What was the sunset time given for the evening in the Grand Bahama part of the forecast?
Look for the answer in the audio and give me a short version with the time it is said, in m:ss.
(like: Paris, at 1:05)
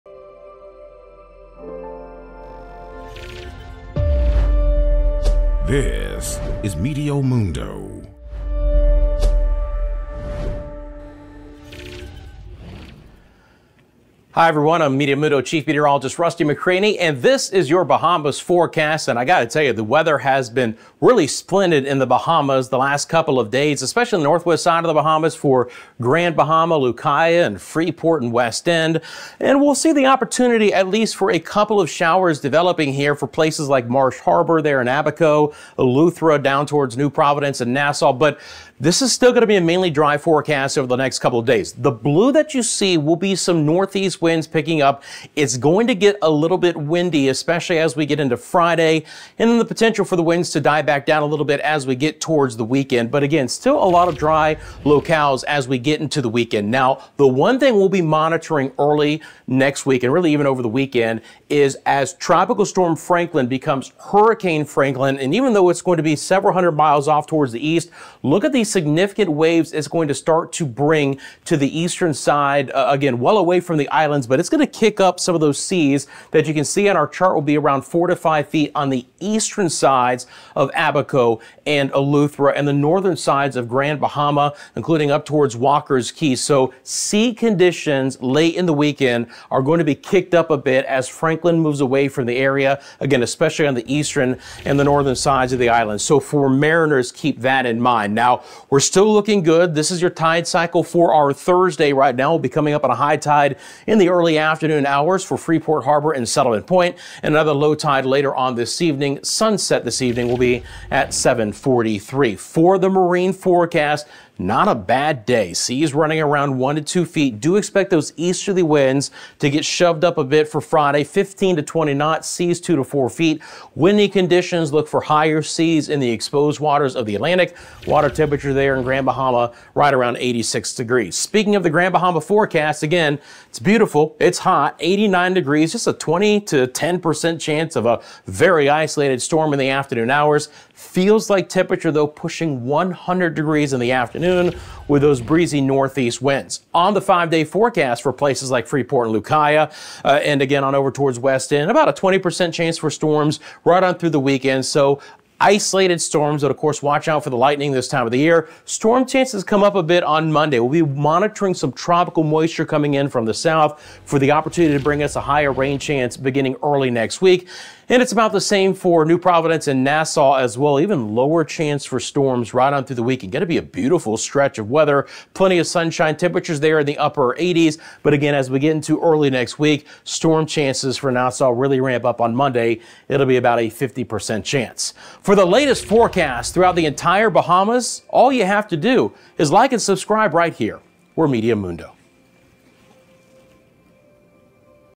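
7:43, at 1:51.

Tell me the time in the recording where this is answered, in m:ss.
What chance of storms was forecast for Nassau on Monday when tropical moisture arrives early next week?
3:03.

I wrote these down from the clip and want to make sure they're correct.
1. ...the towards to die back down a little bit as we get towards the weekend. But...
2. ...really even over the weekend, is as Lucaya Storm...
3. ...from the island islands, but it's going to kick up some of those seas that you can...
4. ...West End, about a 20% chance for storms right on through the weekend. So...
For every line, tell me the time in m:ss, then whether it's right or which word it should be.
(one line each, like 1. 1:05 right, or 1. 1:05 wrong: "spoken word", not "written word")
1. 0:50 wrong: "winds", not "towards"
2. 1:00 wrong: "Tropical", not "Lucaya"
3. 1:13 right
4. 2:31 right.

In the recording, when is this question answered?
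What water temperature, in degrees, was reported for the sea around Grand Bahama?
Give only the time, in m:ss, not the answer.
2:10.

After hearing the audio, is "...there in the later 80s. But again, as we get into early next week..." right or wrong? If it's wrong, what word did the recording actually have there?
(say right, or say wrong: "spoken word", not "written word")
wrong: "upper", not "later".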